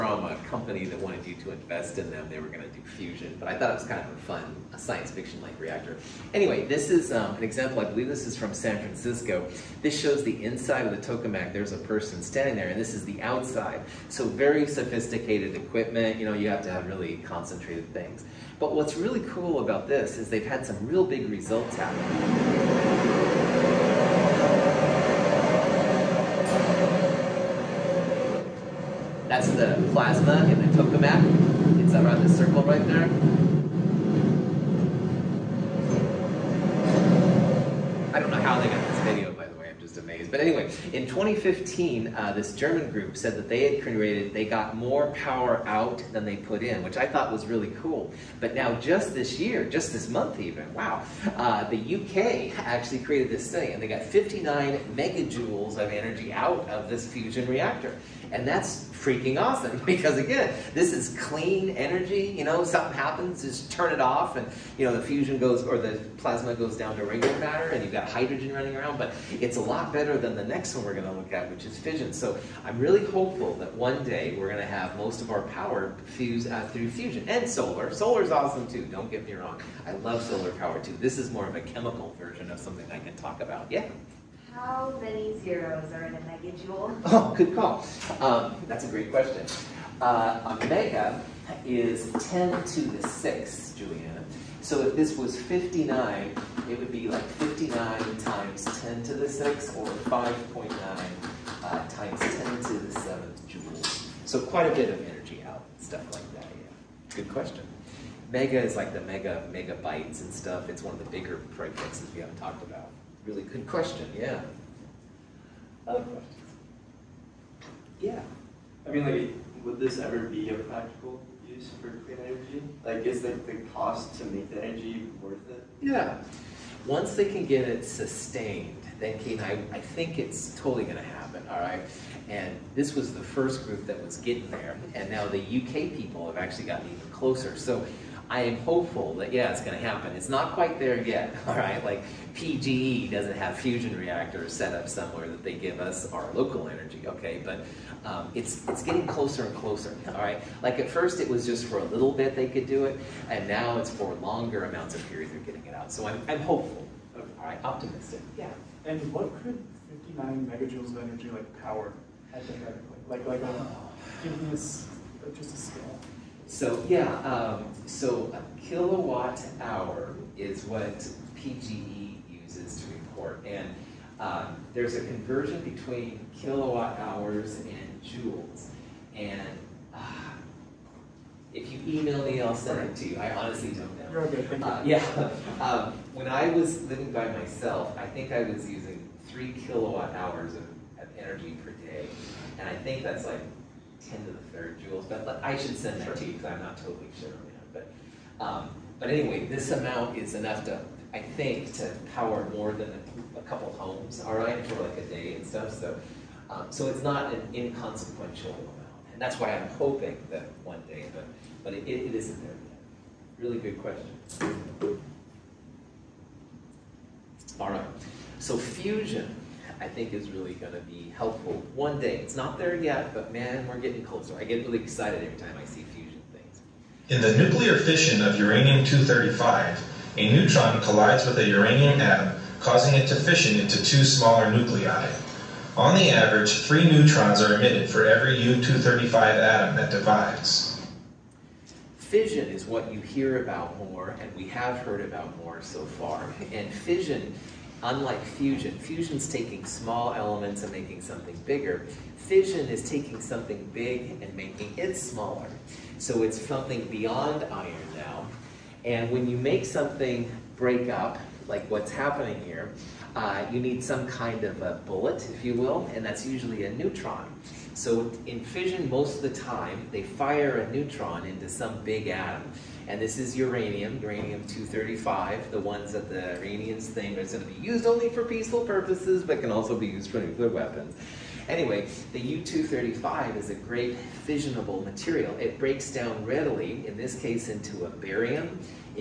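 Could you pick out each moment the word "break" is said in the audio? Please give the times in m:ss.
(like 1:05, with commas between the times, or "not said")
4:20, 4:45.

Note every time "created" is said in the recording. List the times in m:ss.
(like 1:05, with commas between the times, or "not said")
0:43, 0:52.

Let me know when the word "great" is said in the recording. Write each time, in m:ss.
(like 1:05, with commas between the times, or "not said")
1:28, 4:43.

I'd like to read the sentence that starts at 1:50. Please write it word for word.
It's one of the bigger prefixes we haven't talked about.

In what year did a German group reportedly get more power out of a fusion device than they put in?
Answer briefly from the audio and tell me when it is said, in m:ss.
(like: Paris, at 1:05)
2015, at 0:41.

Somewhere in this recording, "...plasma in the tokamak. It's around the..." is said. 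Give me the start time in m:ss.
0:29.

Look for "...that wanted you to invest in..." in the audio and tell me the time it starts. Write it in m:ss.
0:00.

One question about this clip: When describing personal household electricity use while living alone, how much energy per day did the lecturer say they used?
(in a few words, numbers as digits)
3 kilowatt hours.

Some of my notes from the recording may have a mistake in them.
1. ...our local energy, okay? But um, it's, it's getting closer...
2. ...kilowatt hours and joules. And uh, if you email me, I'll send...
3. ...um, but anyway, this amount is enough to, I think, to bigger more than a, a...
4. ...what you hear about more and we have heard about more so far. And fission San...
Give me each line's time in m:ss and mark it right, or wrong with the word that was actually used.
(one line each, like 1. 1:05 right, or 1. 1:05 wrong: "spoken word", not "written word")
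1. 2:26 right
2. 2:56 right
3. 3:18 wrong: "power", not "bigger"
4. 4:02 wrong: "Unlike", not "San".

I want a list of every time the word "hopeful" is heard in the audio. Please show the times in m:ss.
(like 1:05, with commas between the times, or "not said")
1:13, 2:18, 2:36.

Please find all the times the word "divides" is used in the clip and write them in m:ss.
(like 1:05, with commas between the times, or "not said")
3:59.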